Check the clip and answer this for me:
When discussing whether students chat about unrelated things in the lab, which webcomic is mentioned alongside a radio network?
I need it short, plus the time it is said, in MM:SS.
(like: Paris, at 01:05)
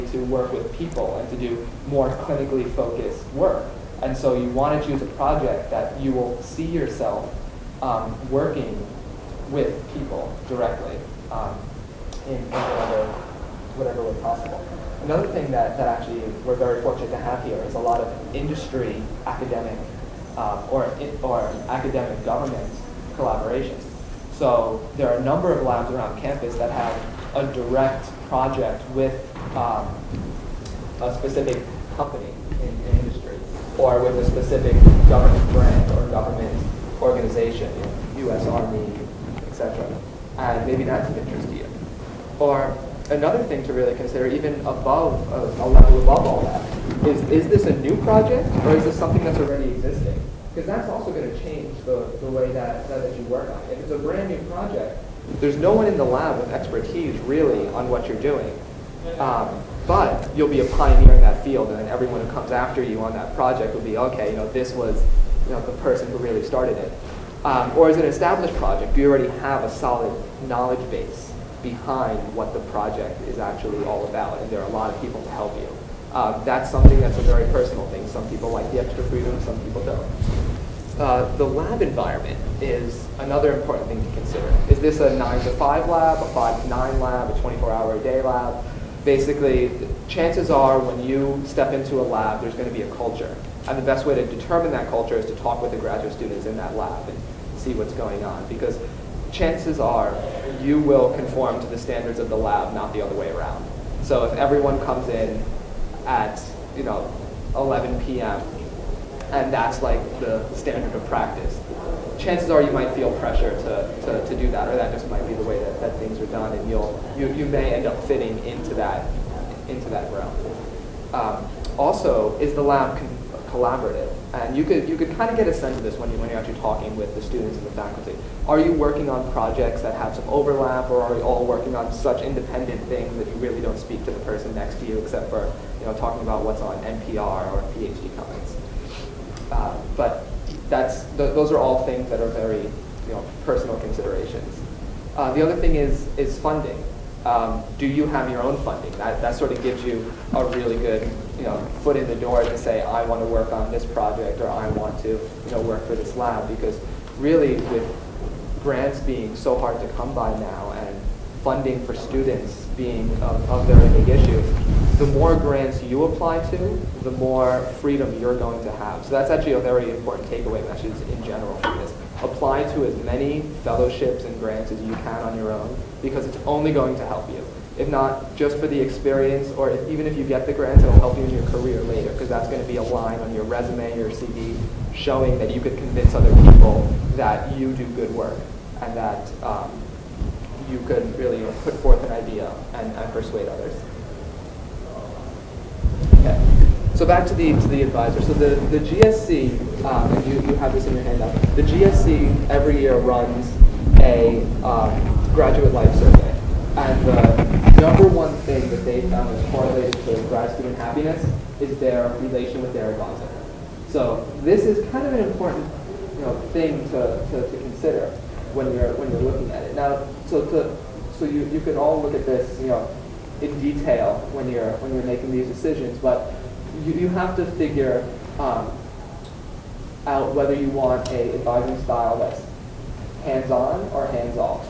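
PhD Comics, at 02:17.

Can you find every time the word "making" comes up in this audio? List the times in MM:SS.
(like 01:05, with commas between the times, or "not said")
03:45.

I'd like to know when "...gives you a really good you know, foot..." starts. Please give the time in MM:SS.
02:29.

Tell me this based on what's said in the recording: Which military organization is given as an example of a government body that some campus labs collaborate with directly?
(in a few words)
U.S. Army.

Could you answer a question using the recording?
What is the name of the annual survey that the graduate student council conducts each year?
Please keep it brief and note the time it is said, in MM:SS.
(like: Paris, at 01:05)
graduate life survey, at 03:25.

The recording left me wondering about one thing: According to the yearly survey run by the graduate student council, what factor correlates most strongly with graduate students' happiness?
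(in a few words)
relation with their advisor.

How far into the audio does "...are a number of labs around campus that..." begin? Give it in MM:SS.
00:25.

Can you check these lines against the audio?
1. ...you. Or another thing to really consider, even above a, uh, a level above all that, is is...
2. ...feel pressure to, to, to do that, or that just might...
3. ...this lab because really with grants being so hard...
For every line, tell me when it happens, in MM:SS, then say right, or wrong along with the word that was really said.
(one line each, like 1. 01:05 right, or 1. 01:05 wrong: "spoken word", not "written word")
1. 00:41 right
2. 01:52 right
3. 02:35 right.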